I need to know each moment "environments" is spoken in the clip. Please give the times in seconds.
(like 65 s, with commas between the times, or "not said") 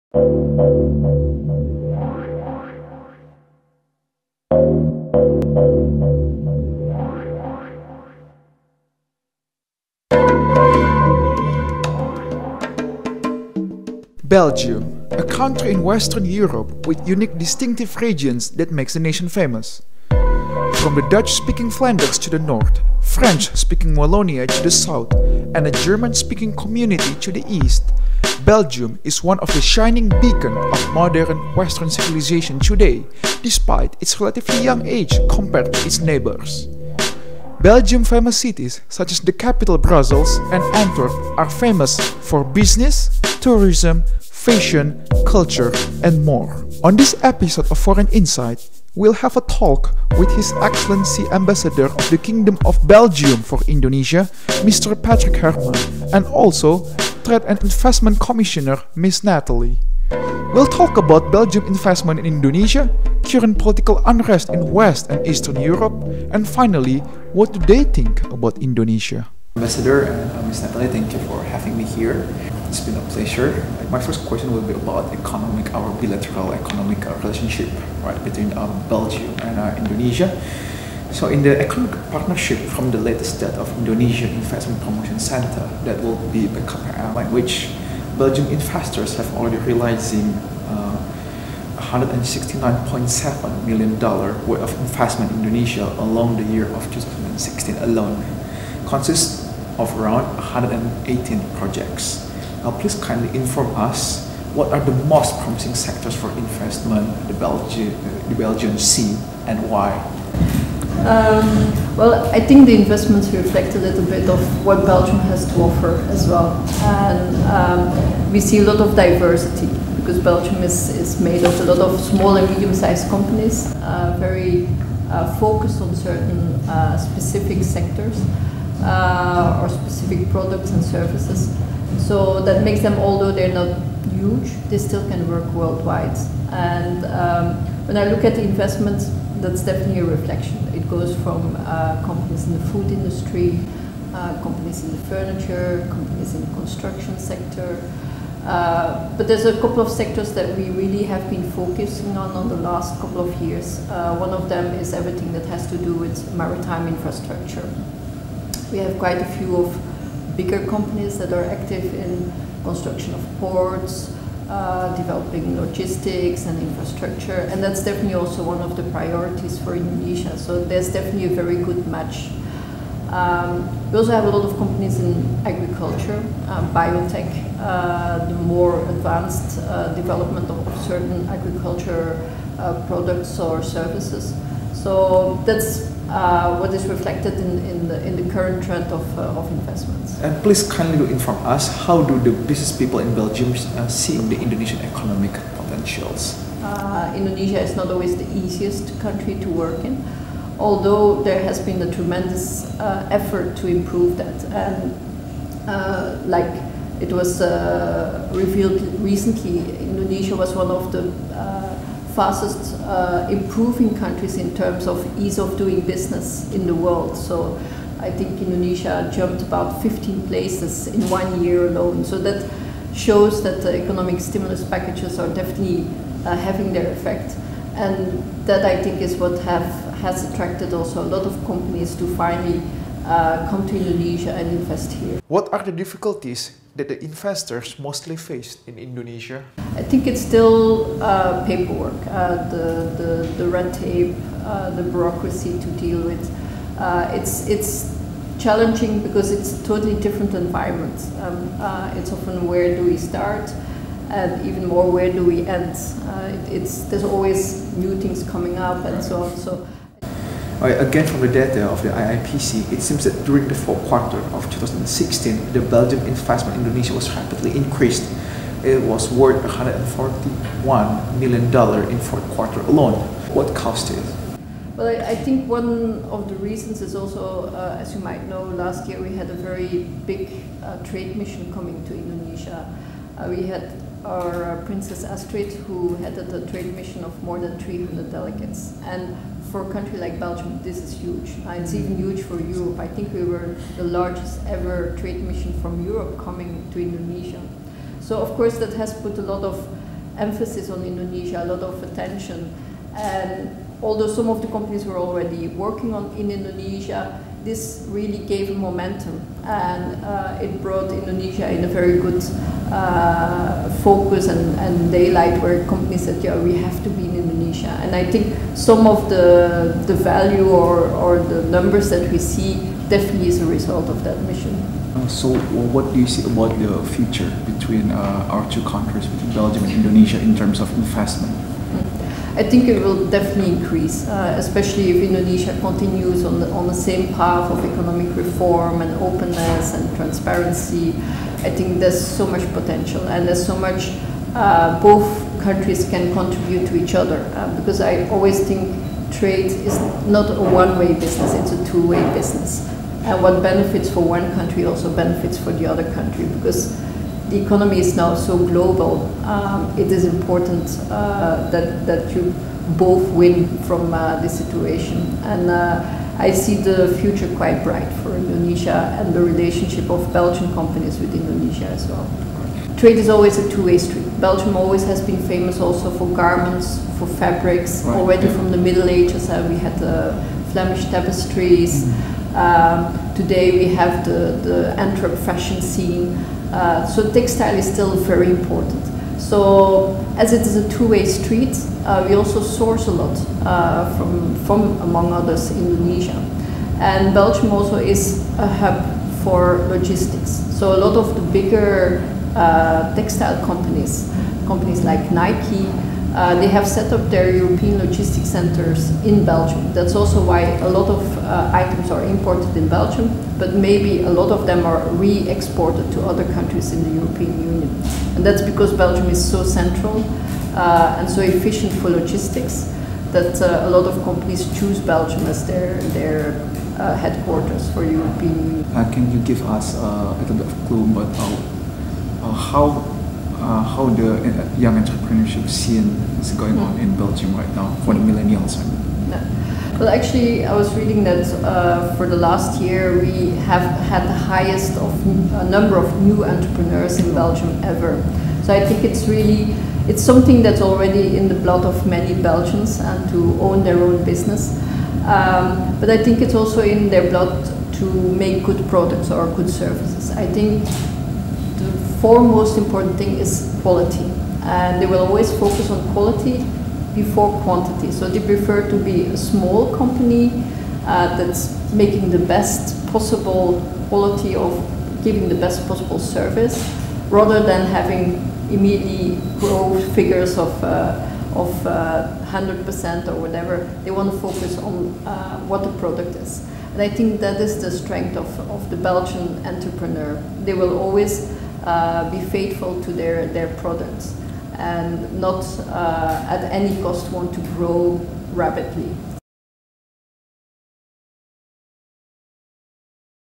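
250 s.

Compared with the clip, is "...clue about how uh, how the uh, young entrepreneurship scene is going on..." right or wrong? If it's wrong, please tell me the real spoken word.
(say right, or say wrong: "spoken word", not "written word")
right.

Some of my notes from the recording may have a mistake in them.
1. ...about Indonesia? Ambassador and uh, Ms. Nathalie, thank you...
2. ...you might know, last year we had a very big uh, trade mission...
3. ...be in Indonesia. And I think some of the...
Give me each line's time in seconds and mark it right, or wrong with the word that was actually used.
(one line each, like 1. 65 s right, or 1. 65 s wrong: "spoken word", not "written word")
1. 68 s right
2. 277 s right
3. 316 s right.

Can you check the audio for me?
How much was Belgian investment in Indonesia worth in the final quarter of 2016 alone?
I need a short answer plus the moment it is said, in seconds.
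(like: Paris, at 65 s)
$141 million, at 269 s.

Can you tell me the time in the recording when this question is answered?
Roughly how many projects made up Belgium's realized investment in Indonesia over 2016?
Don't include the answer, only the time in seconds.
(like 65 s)
100 s.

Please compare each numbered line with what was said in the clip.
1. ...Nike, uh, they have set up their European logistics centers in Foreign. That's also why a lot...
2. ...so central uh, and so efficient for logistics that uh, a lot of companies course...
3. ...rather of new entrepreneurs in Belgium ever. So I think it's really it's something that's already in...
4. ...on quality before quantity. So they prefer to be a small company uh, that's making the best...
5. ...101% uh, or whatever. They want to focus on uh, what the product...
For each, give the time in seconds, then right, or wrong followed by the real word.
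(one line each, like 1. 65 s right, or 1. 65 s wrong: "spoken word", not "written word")
1. 405 s wrong: "Belgium", not "Foreign"
2. 419 s wrong: "choose", not "course"
3. 445 s wrong: "number", not "rather"
4. 465 s right
5. 482 s wrong: "100", not "101".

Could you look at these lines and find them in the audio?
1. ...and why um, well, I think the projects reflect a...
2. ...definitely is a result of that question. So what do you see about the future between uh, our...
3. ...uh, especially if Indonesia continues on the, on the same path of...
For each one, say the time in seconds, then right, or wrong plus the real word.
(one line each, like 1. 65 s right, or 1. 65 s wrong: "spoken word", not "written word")
1. 109 s wrong: "investments", not "projects"
2. 322 s wrong: "mission", not "question"
3. 334 s right.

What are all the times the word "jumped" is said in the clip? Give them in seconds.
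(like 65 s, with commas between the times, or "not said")
219 s.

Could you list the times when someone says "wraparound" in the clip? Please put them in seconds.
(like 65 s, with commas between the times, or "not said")
not said.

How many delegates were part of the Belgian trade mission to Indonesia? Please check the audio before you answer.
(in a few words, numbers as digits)
more than 300.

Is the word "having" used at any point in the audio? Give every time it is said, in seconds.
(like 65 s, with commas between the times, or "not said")
71 s, 226 s, 477 s.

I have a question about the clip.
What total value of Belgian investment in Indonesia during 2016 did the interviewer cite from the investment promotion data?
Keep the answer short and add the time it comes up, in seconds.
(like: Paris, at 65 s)
$169.7 million, at 91 s.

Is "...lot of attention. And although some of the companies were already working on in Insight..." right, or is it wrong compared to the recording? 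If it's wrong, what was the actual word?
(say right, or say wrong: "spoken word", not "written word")
wrong: "Indonesia", not "Insight".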